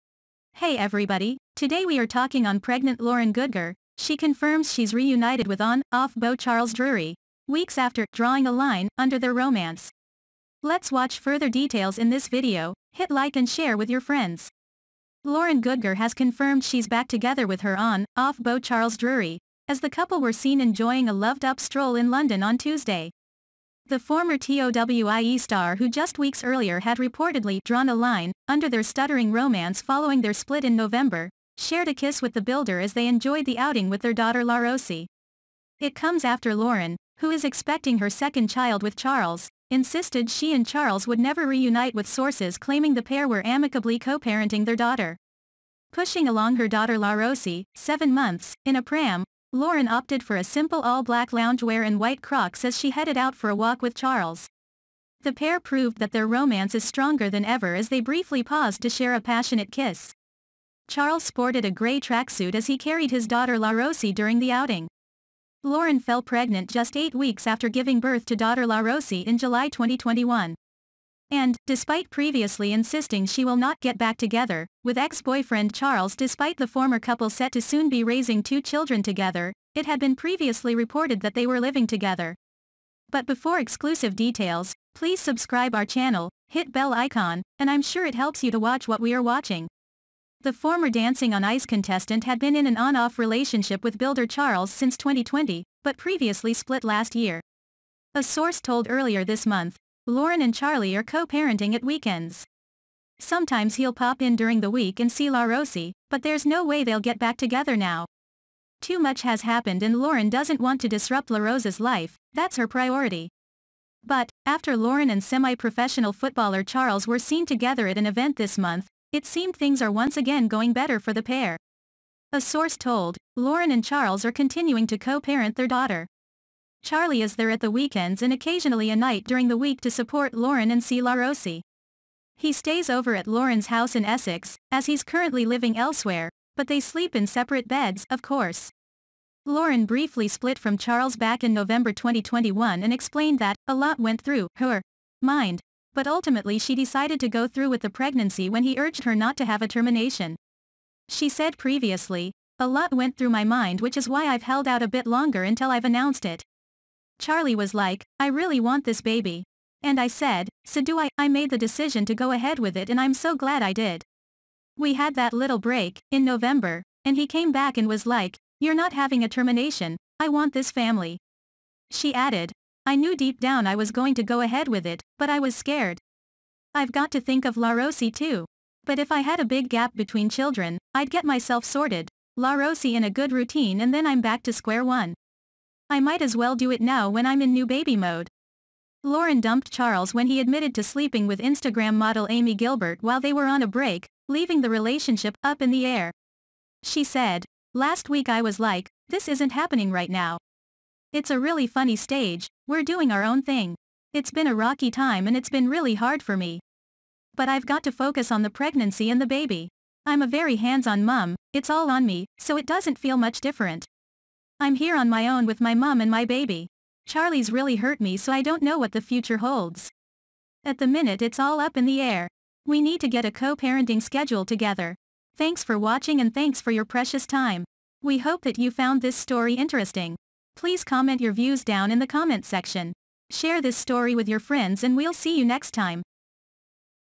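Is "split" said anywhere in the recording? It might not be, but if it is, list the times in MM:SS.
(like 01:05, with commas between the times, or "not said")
00:30, 01:36, 02:20.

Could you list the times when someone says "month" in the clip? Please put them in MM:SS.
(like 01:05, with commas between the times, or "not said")
00:48, 01:39, 01:58.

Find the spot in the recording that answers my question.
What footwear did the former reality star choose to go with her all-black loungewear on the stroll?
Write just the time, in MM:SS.
00:51.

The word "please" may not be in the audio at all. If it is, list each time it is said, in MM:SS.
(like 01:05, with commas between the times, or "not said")
01:24, 03:50.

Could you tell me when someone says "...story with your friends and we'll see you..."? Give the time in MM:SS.
03:53.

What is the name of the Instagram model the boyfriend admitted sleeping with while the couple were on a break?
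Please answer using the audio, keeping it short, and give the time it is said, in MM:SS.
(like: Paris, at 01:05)
Amy Gilbert, at 03:12.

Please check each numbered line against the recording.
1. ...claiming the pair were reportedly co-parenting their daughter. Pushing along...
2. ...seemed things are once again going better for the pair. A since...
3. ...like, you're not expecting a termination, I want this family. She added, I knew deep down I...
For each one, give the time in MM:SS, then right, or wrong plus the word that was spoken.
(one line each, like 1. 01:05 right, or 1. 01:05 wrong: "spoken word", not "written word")
1. 00:42 wrong: "amicably", not "reportedly"
2. 01:59 wrong: "source", not "since"
3. 02:48 wrong: "having", not "expecting".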